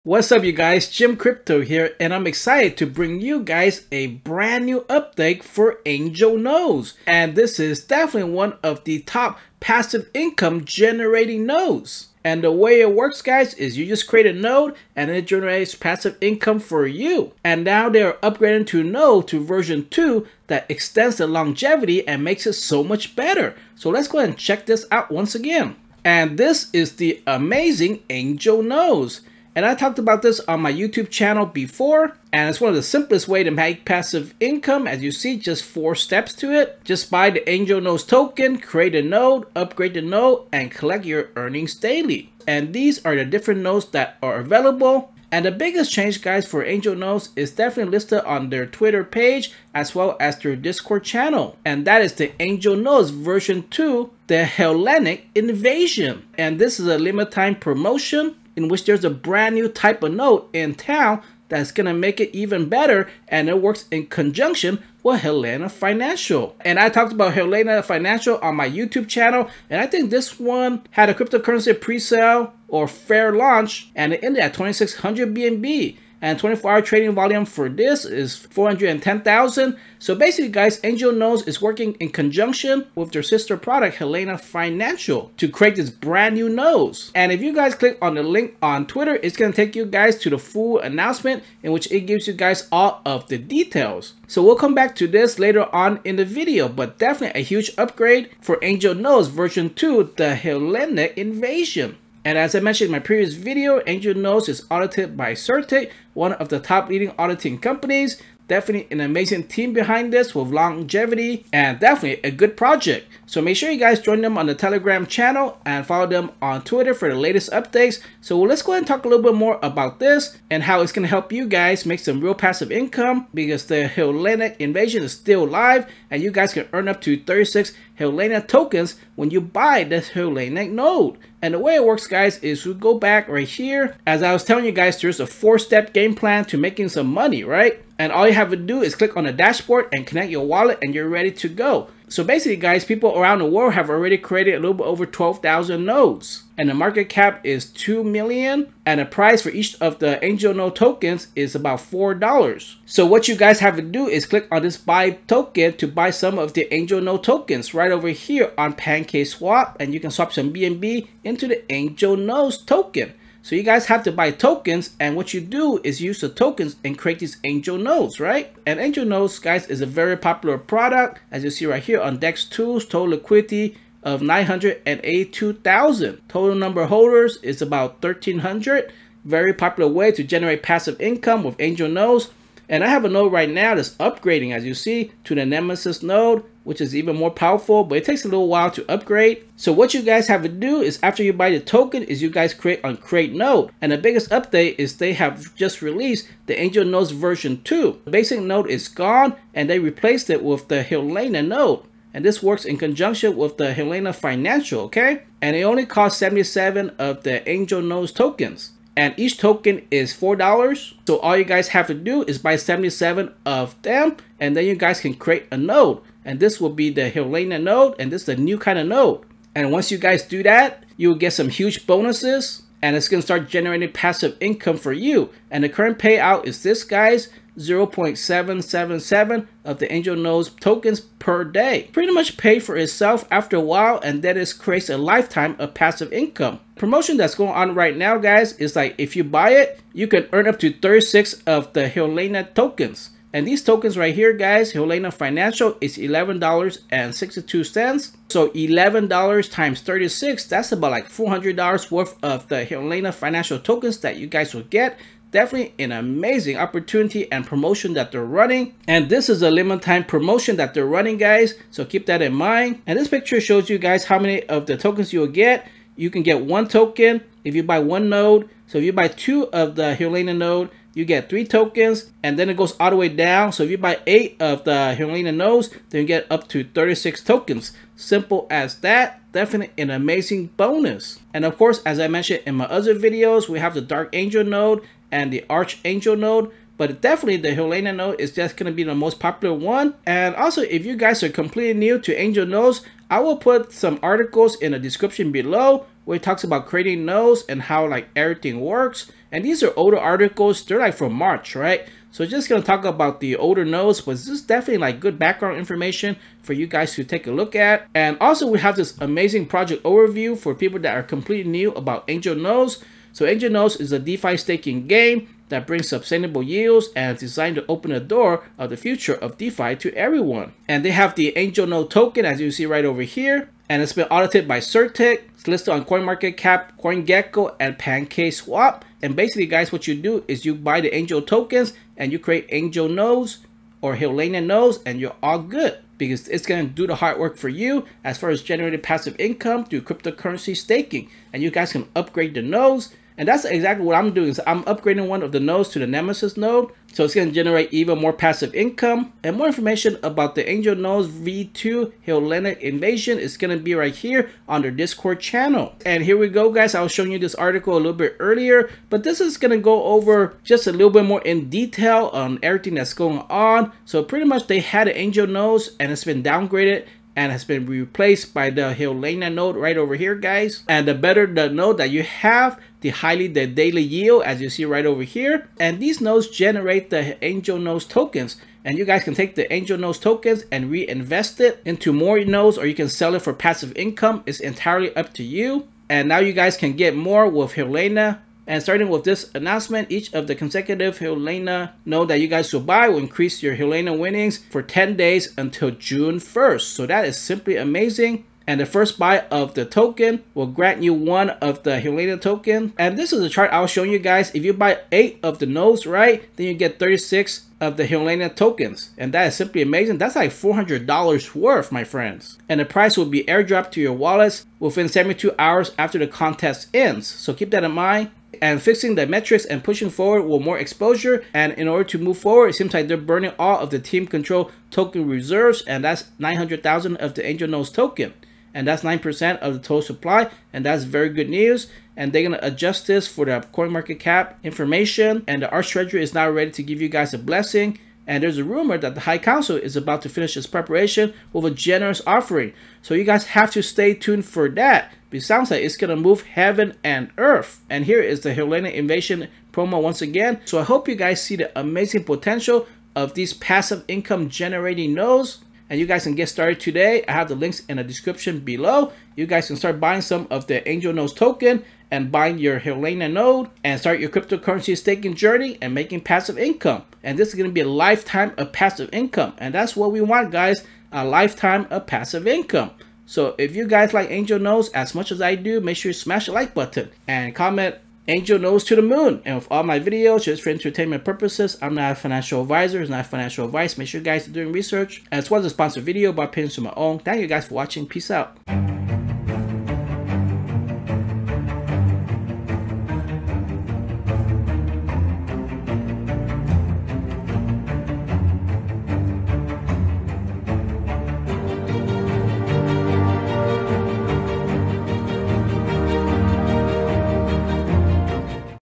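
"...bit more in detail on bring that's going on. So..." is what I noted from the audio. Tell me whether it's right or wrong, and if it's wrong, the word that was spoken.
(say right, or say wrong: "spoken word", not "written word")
wrong: "everything", not "bring".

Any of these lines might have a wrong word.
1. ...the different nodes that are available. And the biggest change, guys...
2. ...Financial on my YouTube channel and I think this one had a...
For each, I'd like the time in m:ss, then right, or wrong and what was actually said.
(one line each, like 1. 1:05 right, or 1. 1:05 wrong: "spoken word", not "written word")
1. 0:43 right
2. 1:07 right.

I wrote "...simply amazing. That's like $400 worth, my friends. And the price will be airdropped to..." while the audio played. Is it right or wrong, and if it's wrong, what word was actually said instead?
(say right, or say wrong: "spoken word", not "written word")
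right.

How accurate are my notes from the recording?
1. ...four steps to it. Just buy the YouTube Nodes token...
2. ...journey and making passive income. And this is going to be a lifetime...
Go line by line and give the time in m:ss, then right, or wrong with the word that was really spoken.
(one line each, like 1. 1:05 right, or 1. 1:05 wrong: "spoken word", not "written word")
1. 0:35 wrong: "Angel", not "YouTube"
2. 7:45 right.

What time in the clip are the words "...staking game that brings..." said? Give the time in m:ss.
5:14.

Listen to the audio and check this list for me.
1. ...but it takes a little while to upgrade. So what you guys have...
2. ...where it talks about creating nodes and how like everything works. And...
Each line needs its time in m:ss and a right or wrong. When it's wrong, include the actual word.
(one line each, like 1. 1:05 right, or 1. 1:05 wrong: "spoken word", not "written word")
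1. 3:07 right
2. 4:56 right.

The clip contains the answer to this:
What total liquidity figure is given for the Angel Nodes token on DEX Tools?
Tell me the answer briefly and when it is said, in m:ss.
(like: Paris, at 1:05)
982,000, at 2:54.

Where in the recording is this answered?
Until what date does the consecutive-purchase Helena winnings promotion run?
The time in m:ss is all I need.
6:35.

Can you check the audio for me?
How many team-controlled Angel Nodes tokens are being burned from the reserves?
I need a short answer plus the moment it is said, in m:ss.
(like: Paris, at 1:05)
900,000, at 7:06.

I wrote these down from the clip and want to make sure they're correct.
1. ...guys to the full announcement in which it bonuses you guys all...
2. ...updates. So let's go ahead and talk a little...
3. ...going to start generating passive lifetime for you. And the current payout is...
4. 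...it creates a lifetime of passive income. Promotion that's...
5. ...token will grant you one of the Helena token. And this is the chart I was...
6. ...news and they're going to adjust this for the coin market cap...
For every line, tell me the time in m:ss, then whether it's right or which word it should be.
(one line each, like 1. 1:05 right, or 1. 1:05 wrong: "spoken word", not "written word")
1. 1:29 wrong: "gives", not "bonuses"
2. 1:57 right
3. 3:43 wrong: "income", not "lifetime"
4. 3:54 right
5. 6:39 right
6. 7:11 right.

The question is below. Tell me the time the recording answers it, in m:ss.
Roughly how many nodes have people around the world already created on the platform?
2:25.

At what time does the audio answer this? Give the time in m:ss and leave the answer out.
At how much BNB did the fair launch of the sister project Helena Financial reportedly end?
1:14.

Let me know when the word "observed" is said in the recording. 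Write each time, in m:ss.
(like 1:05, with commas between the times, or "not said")
not said.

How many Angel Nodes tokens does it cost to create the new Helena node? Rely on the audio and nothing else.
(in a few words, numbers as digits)
77.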